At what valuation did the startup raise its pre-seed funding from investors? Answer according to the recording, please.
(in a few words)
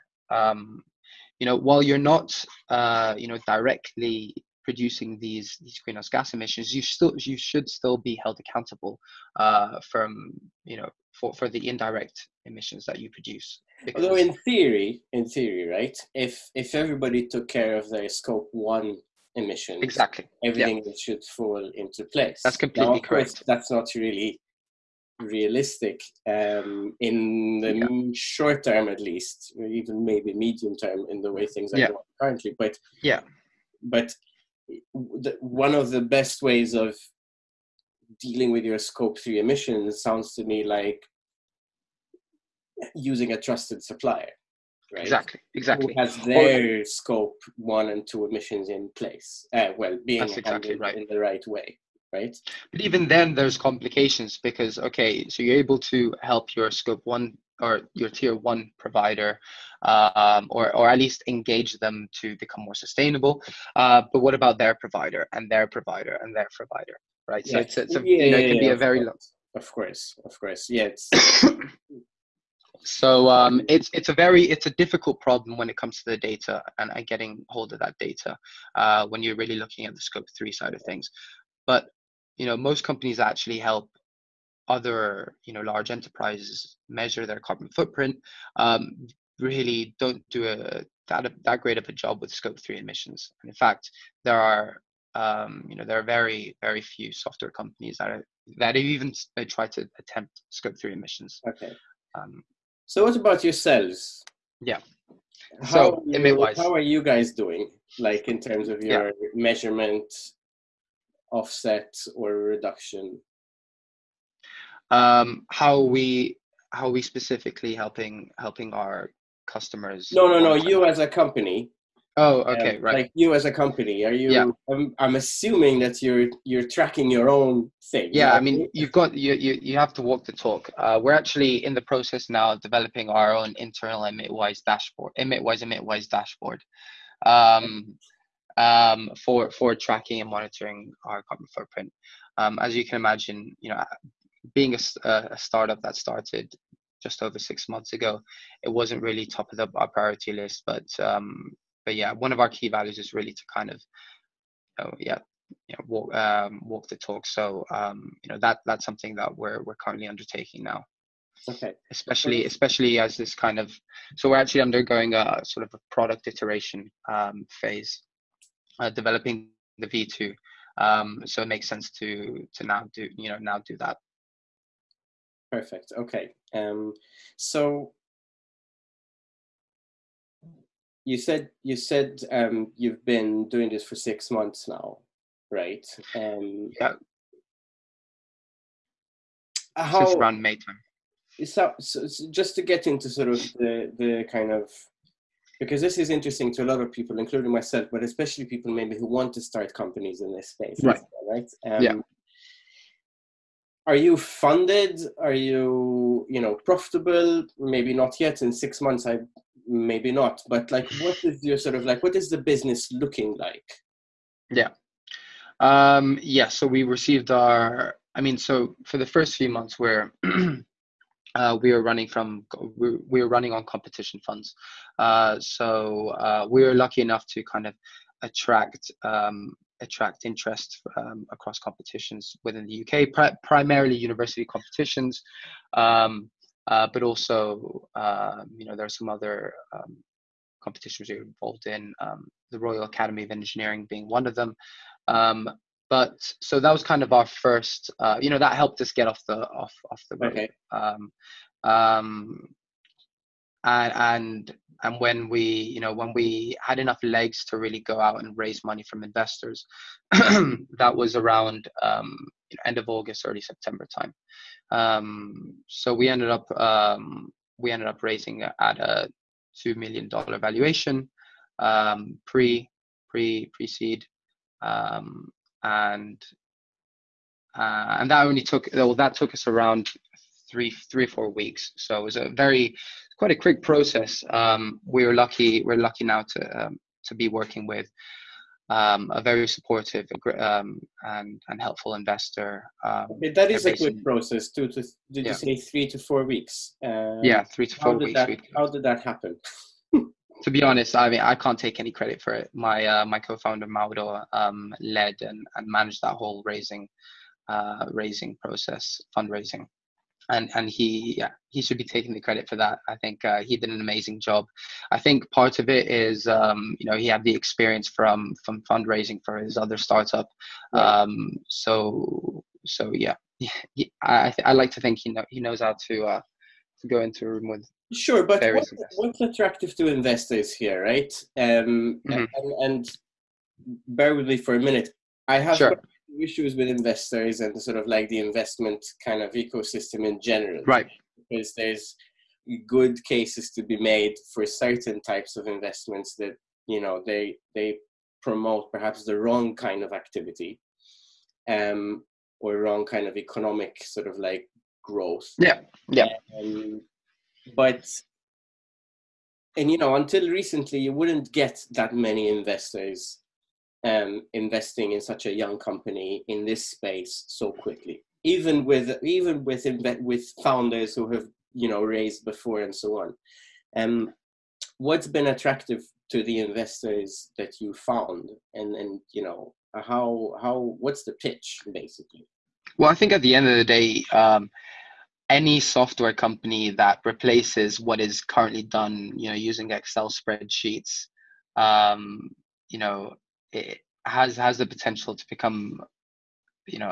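$2 million.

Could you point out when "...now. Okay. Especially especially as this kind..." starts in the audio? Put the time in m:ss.
2:40.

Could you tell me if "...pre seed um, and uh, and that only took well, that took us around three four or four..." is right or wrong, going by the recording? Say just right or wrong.
wrong.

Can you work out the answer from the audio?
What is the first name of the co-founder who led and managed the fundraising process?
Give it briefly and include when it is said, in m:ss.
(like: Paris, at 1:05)
Mauro, at 5:03.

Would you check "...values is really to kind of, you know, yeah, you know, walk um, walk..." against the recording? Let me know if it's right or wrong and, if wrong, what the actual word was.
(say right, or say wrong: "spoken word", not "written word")
right.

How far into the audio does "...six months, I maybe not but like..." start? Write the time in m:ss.
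3:28.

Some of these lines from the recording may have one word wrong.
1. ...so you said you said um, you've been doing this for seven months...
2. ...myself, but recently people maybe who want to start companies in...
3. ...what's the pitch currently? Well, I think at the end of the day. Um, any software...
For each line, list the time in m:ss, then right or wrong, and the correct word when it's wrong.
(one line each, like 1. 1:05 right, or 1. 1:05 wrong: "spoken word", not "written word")
1. 2:57 wrong: "six", not "seven"
2. 3:17 wrong: "especially", not "recently"
3. 6:20 wrong: "basically", not "currently".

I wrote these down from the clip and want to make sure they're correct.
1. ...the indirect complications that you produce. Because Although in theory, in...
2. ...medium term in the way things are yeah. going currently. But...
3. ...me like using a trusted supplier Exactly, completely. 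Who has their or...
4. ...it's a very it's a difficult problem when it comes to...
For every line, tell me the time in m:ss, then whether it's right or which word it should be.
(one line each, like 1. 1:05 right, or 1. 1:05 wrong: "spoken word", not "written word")
1. 0:11 wrong: "emissions", not "complications"
2. 0:30 right
3. 0:40 wrong: "exactly", not "completely"
4. 1:13 right.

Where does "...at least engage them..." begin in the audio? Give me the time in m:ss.
1:00.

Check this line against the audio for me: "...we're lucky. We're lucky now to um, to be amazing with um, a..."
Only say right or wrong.
wrong.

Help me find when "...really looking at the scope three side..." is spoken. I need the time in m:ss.
1:19.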